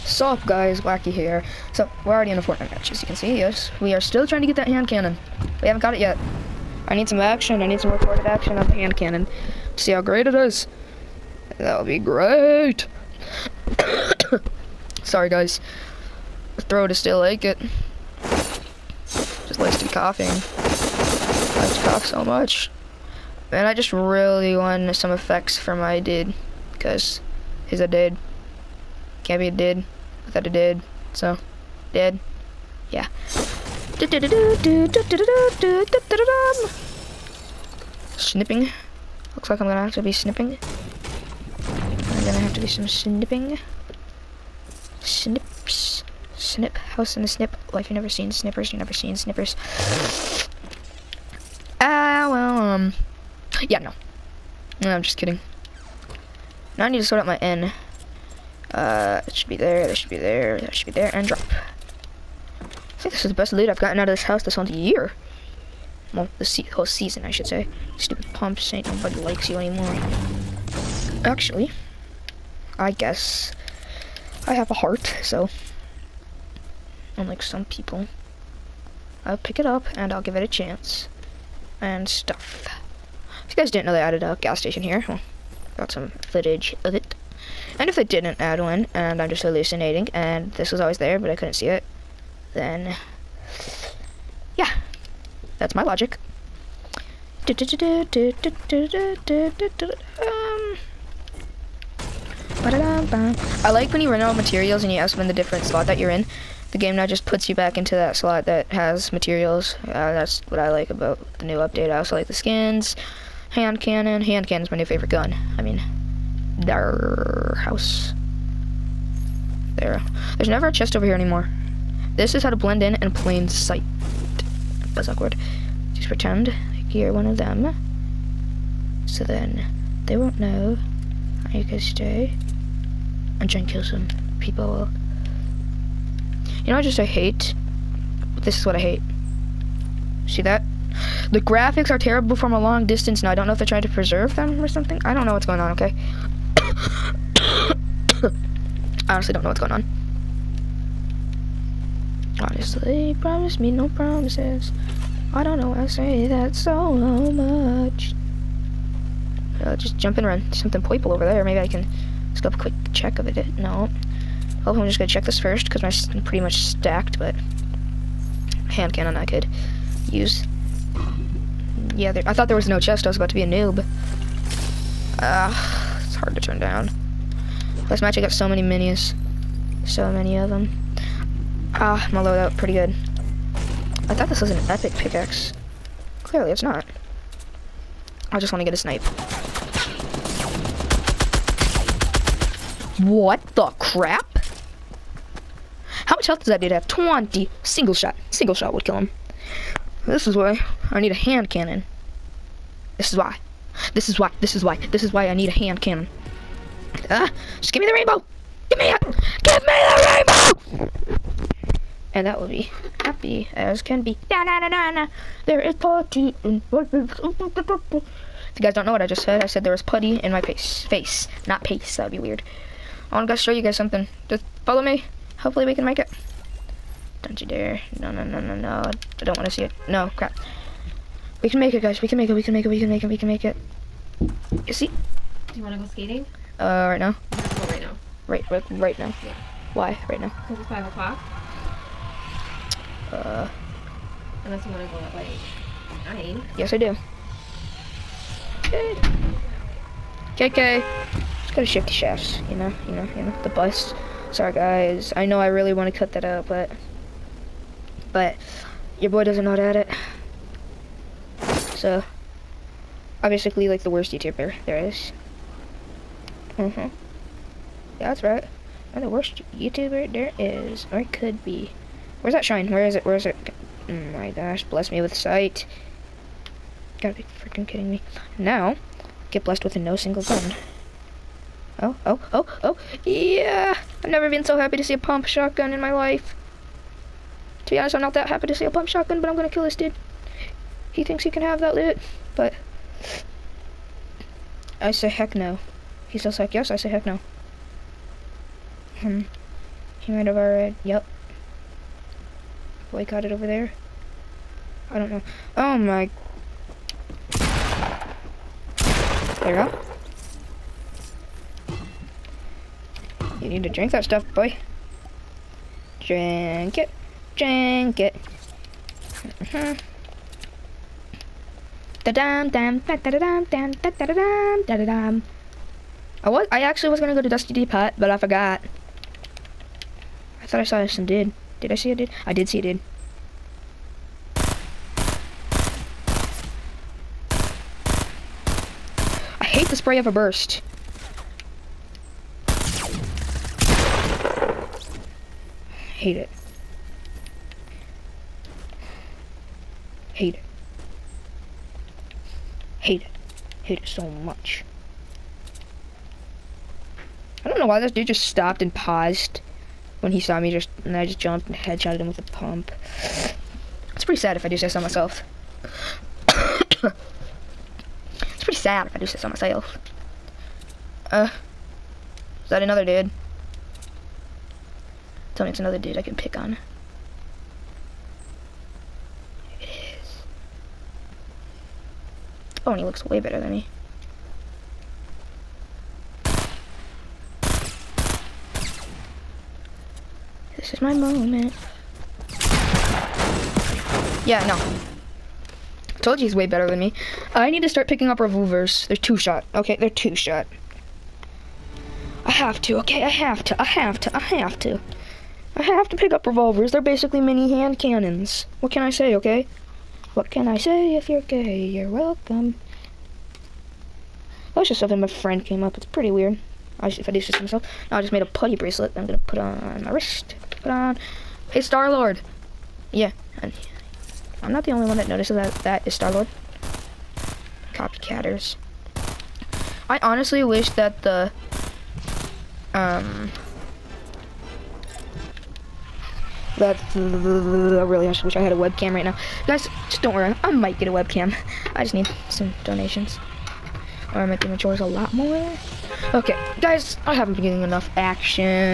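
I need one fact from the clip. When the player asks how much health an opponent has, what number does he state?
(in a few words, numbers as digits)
20.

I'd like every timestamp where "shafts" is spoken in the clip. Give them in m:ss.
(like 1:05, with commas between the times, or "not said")
4:11.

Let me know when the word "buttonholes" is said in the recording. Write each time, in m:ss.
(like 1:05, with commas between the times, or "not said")
not said.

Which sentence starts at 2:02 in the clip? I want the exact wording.
This is how to blend in in plain sight was awkward.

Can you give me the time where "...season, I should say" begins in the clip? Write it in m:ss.
1:06.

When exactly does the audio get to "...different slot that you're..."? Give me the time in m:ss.
1:45.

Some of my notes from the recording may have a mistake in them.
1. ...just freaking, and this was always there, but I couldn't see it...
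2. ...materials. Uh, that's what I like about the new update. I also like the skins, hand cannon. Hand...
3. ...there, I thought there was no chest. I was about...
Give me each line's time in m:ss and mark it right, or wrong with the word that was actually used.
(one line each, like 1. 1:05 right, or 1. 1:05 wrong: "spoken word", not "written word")
1. 1:29 wrong: "hallucinating", not "freaking"
2. 1:49 right
3. 2:52 right.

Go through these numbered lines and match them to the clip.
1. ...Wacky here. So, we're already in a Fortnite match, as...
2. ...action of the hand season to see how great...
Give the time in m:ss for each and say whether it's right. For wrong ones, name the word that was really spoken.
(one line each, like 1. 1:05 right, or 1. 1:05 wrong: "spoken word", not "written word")
1. 0:00 right
2. 0:08 wrong: "cannon", not "season".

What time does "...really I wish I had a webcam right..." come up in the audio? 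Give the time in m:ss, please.
7:16.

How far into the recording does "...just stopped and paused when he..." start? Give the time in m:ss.
5:58.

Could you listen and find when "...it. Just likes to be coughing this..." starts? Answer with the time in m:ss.
0:17.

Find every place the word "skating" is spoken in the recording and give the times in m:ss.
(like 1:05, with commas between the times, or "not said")
3:55.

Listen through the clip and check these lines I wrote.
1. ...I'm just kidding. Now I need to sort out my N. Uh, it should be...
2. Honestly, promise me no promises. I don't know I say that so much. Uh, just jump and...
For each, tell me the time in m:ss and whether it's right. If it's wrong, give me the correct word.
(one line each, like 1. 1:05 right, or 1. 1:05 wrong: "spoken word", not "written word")
1. 0:54 right
2. 2:32 right.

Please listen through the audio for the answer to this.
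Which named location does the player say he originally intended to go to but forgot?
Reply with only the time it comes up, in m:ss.
5:27.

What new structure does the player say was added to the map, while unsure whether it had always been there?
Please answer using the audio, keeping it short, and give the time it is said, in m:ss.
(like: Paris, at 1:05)
gas station, at 1:24.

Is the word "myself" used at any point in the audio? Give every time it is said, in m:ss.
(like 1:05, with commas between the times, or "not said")
6:04, 6:09, 6:57.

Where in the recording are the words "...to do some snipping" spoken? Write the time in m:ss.
0:42.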